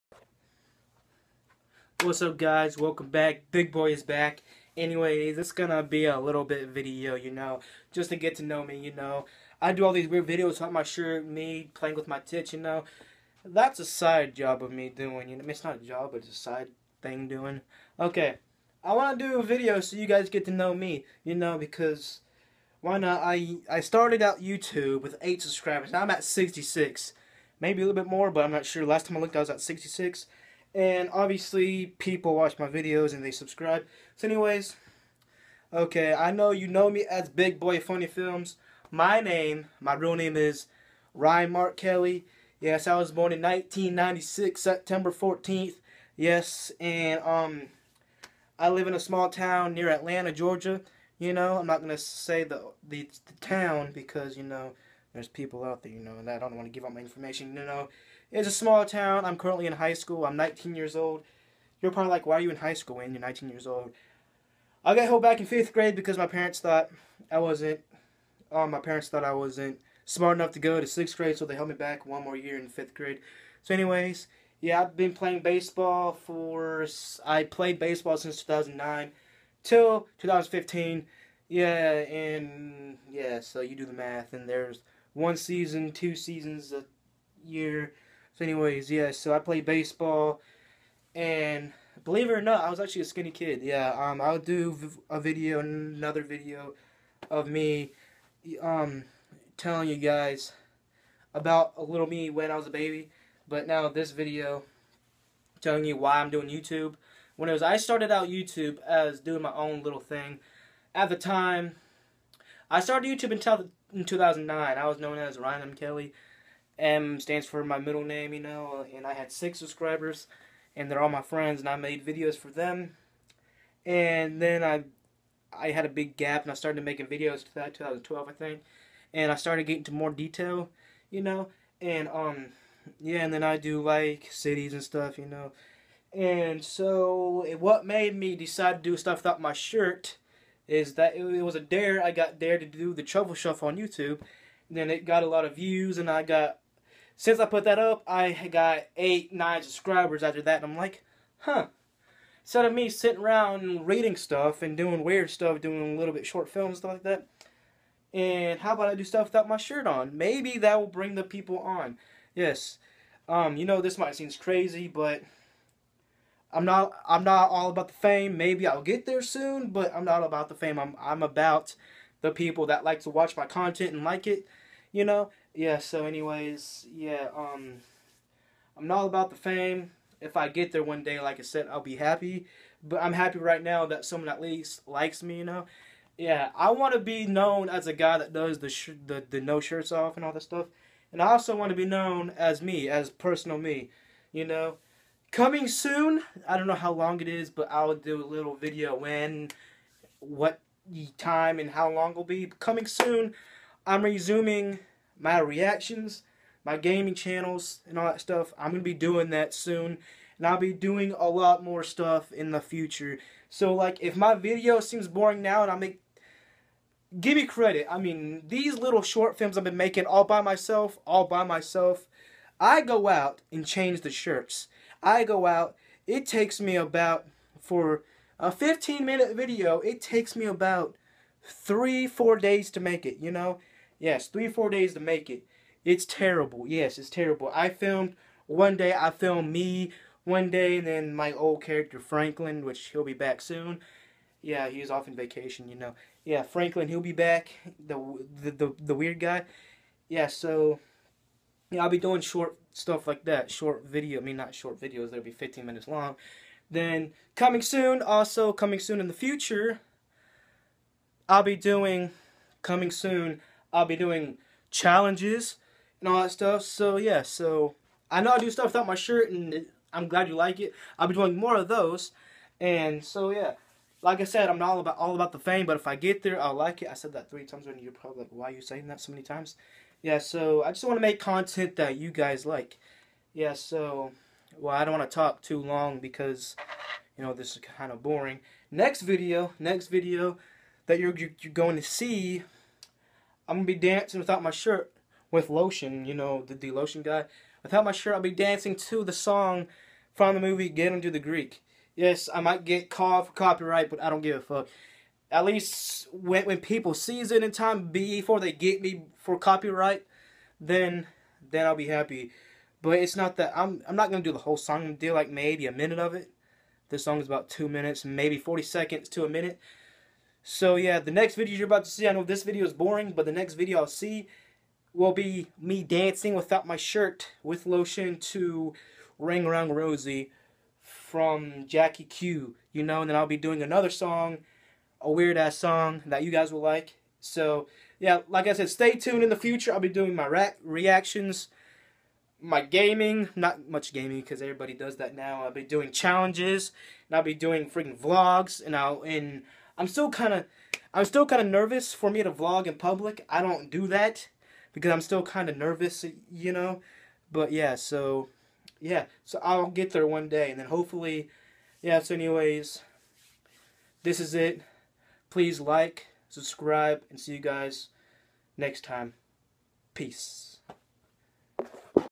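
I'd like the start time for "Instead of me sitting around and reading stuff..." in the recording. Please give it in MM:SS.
02:32.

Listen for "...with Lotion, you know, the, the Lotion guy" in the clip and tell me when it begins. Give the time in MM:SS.
04:55.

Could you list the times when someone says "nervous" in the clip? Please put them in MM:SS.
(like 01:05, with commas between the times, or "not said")
05:51, 05:55.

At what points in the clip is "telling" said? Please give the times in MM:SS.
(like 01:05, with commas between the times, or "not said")
01:39, 01:45.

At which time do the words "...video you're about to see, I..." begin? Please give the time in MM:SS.
05:21.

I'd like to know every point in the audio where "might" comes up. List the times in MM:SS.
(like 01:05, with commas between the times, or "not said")
02:43, 05:02.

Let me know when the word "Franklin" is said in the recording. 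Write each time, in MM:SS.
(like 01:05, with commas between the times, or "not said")
04:01, 04:06.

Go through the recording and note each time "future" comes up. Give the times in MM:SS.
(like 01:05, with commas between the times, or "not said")
03:32, 04:19, 05:39.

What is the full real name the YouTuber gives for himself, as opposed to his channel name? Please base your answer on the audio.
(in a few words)
Ryan Mark Kelly.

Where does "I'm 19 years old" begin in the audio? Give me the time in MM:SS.
01:00.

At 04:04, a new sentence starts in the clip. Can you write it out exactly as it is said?
Yeah, he's off on vacation, you know.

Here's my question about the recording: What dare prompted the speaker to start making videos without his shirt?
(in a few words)
The truffle shuffle.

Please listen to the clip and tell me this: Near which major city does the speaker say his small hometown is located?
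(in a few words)
Atlanta, Georgia.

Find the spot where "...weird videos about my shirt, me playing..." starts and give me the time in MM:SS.
00:10.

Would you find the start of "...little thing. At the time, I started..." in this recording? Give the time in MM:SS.
01:49.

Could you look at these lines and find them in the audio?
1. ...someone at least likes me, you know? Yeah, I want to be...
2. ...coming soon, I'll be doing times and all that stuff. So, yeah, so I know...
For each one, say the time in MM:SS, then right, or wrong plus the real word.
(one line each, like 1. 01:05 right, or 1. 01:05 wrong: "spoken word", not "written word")
1. 03:04 right
2. 04:22 wrong: "challenges", not "times".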